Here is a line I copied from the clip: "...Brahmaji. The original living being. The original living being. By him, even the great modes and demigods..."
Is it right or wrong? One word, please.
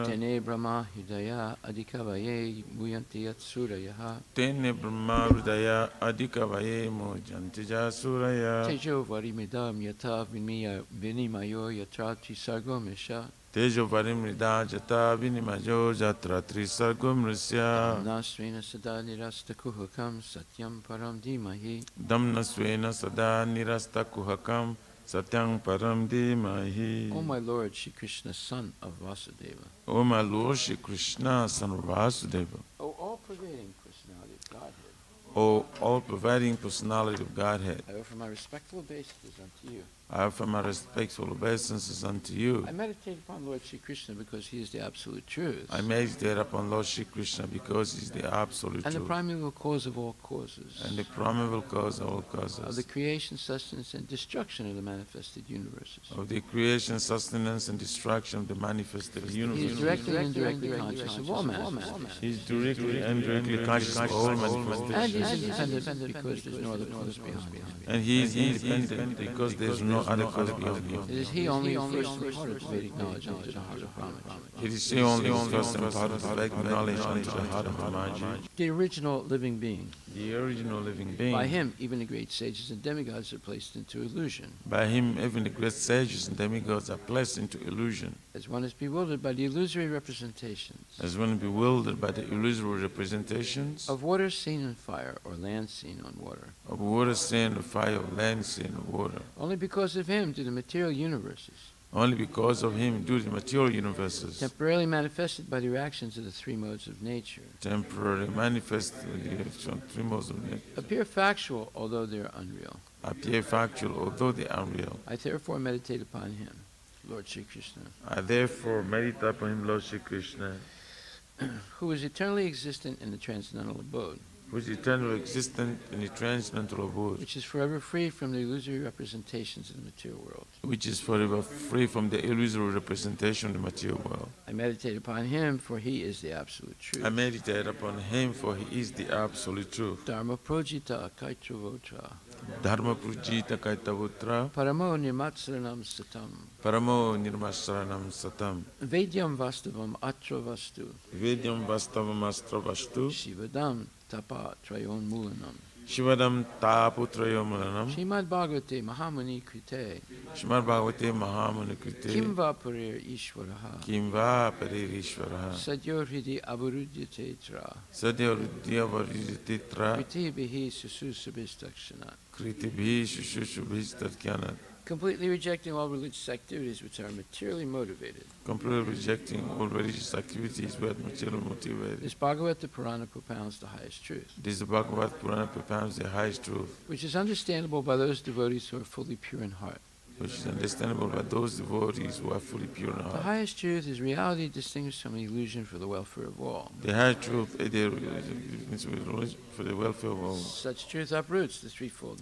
wrong.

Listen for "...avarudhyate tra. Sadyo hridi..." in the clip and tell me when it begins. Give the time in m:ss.
2:46.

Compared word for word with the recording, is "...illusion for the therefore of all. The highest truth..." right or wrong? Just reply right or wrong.
wrong.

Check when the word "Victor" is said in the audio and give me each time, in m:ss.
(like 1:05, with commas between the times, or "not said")
not said.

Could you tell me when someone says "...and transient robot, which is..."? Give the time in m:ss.
2:05.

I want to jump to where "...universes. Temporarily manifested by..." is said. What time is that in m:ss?
1:43.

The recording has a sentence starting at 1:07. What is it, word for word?
And he is independent because there's no other cause beyond him.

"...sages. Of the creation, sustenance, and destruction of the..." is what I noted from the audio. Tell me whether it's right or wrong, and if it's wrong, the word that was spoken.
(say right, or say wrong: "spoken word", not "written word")
wrong: "causes", not "sages".